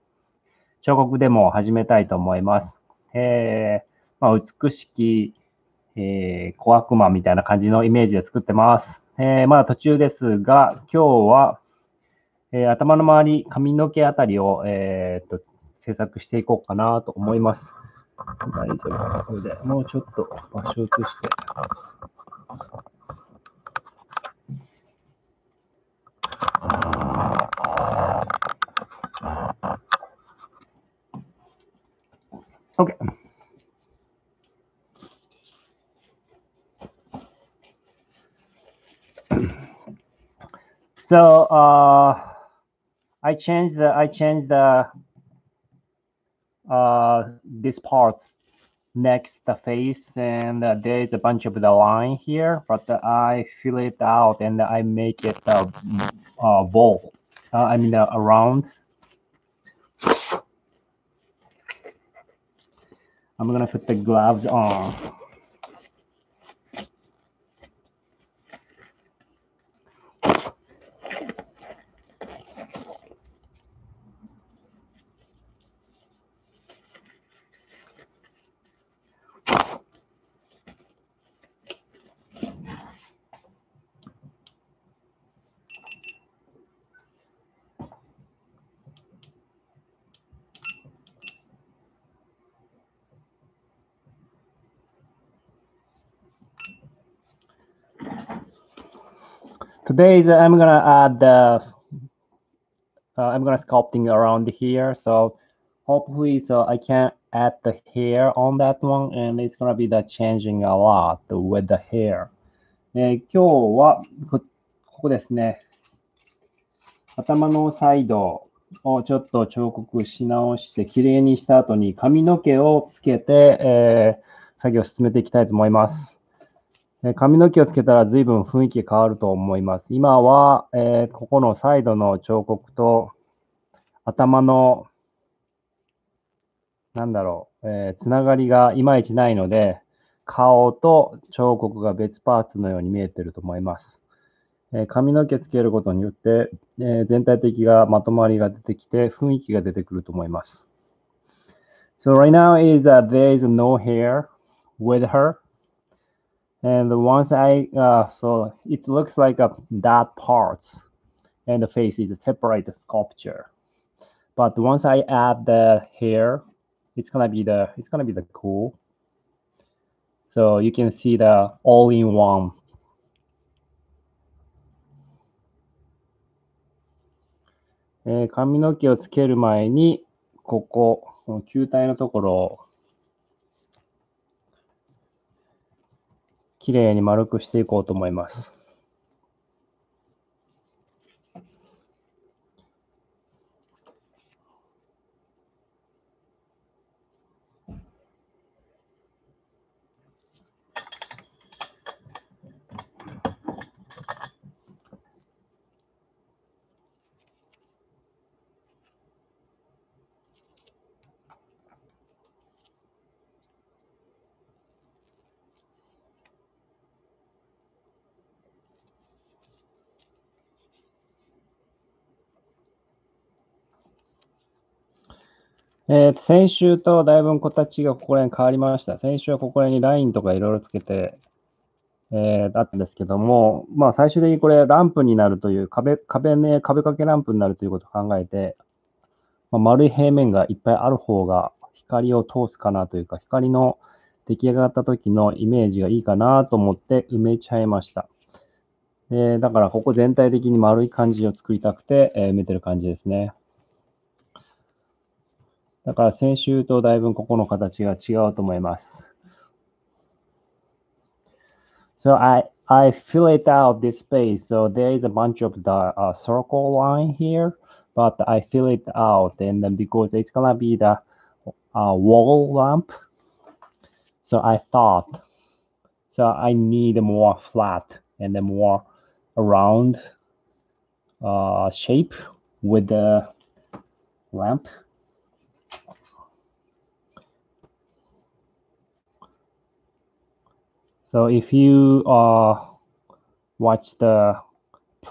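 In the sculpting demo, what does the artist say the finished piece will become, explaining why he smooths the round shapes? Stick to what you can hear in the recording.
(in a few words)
wall lamp.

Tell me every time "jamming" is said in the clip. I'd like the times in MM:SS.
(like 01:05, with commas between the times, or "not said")
not said.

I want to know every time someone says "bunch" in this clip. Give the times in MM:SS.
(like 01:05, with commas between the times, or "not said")
00:51, 04:25.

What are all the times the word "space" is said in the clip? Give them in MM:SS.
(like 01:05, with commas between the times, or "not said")
04:23.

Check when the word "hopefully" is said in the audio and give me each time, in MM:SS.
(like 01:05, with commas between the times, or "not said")
01:45.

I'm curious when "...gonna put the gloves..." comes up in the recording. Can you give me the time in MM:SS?
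01:03.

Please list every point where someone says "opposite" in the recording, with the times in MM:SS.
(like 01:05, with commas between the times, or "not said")
not said.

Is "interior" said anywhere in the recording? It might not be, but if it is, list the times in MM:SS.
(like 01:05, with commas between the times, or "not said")
not said.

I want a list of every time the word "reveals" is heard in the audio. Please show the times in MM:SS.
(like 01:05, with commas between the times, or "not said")
not said.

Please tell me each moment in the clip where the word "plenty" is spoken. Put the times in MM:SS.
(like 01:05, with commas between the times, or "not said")
not said.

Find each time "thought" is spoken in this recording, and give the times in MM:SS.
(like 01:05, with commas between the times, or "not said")
04:34.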